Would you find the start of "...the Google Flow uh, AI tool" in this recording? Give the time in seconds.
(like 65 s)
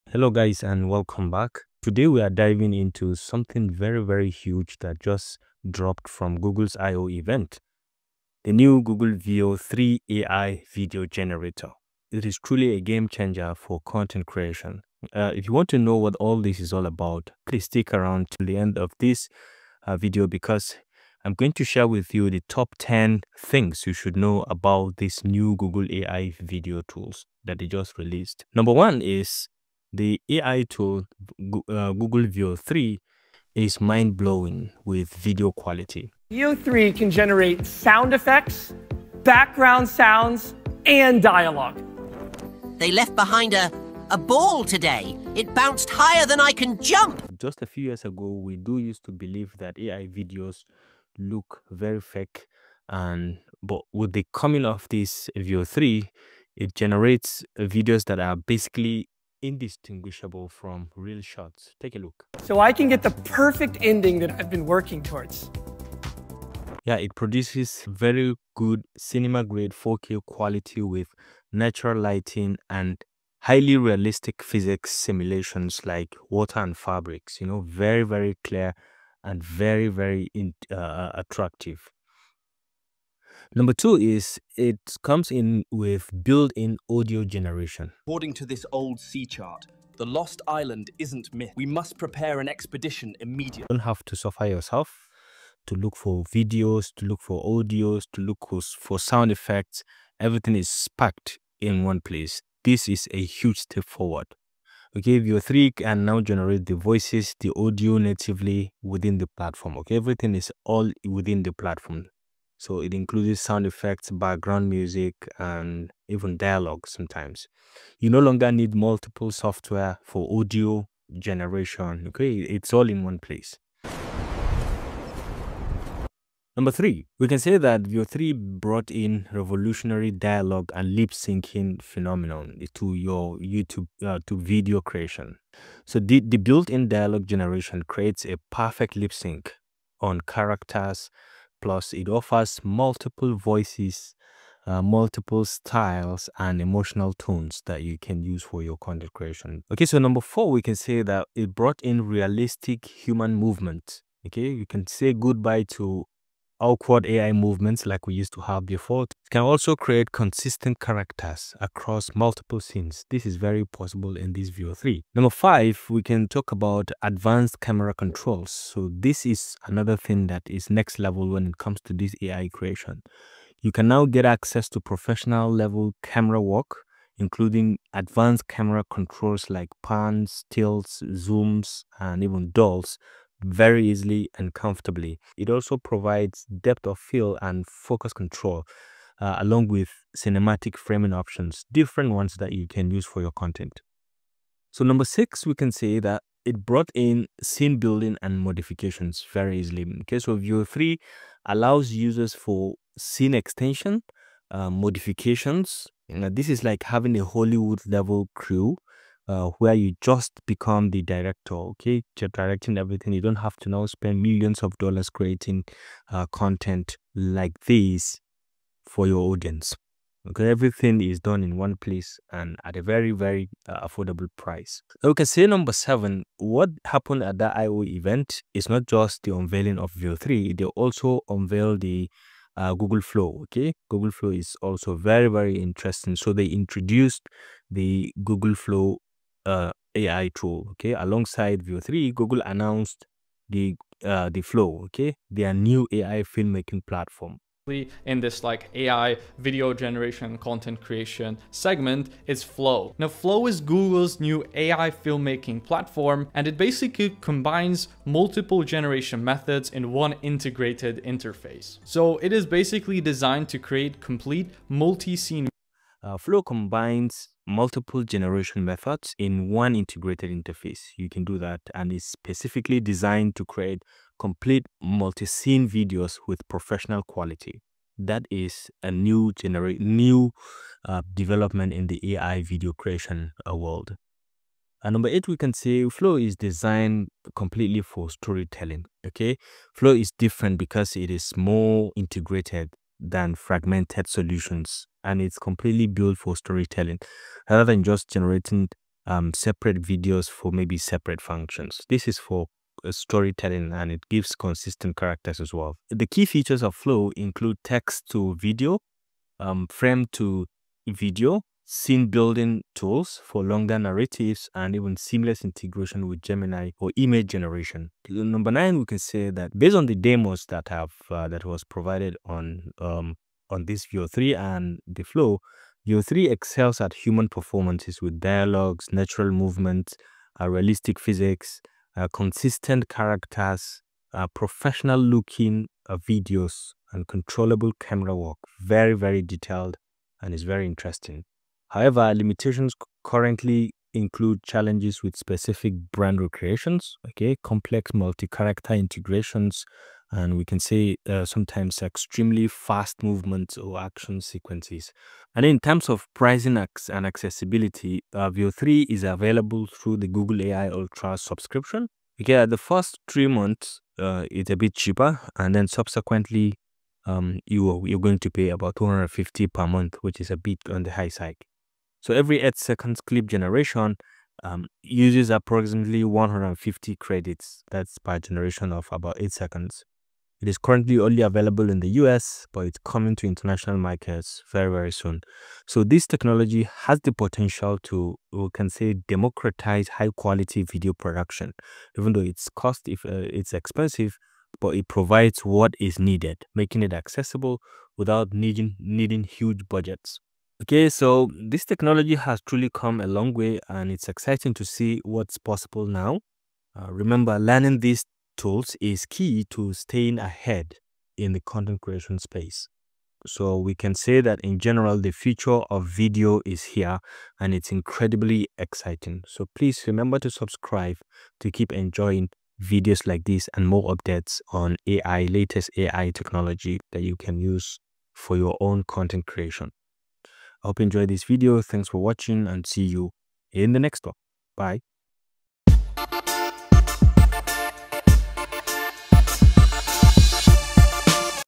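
237 s.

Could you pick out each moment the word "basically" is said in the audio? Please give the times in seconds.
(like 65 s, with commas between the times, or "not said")
58 s, 256 s, 262 s.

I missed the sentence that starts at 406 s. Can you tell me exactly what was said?
Uh, remember, learning these tools is key to staying ahead in the content creation space.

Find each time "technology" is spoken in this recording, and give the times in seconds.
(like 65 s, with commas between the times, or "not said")
386 s, 401 s, 426 s.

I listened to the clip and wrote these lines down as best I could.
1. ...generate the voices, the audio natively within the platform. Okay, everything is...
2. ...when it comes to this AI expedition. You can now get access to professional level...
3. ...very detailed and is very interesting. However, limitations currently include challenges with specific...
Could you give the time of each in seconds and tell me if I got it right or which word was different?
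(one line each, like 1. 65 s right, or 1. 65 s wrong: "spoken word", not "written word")
1. 106 s right
2. 171 s wrong: "creation", not "expedition"
3. 338 s right.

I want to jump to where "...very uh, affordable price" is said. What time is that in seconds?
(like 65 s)
223 s.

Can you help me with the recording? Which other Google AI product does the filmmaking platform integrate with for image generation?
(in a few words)
Gemini.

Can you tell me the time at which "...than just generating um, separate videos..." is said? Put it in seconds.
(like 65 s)
297 s.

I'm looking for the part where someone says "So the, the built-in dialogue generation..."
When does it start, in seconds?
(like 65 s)
135 s.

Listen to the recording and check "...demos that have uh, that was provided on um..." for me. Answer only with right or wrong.
right.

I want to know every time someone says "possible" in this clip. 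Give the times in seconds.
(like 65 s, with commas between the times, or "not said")
163 s, 405 s.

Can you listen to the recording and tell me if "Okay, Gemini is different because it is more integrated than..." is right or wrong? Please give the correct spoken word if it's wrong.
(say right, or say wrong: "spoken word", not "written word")
wrong: "Flow", not "Gemini".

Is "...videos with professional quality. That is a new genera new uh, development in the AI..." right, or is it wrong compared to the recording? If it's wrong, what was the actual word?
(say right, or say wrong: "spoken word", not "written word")
right.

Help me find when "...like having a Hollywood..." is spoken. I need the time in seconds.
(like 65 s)
206 s.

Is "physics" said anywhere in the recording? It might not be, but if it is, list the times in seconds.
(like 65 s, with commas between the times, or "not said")
74 s, 330 s.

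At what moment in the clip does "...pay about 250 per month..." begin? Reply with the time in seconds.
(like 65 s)
368 s.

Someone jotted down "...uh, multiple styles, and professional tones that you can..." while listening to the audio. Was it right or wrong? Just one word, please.
wrong.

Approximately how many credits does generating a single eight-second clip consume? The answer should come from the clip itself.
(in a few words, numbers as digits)
150.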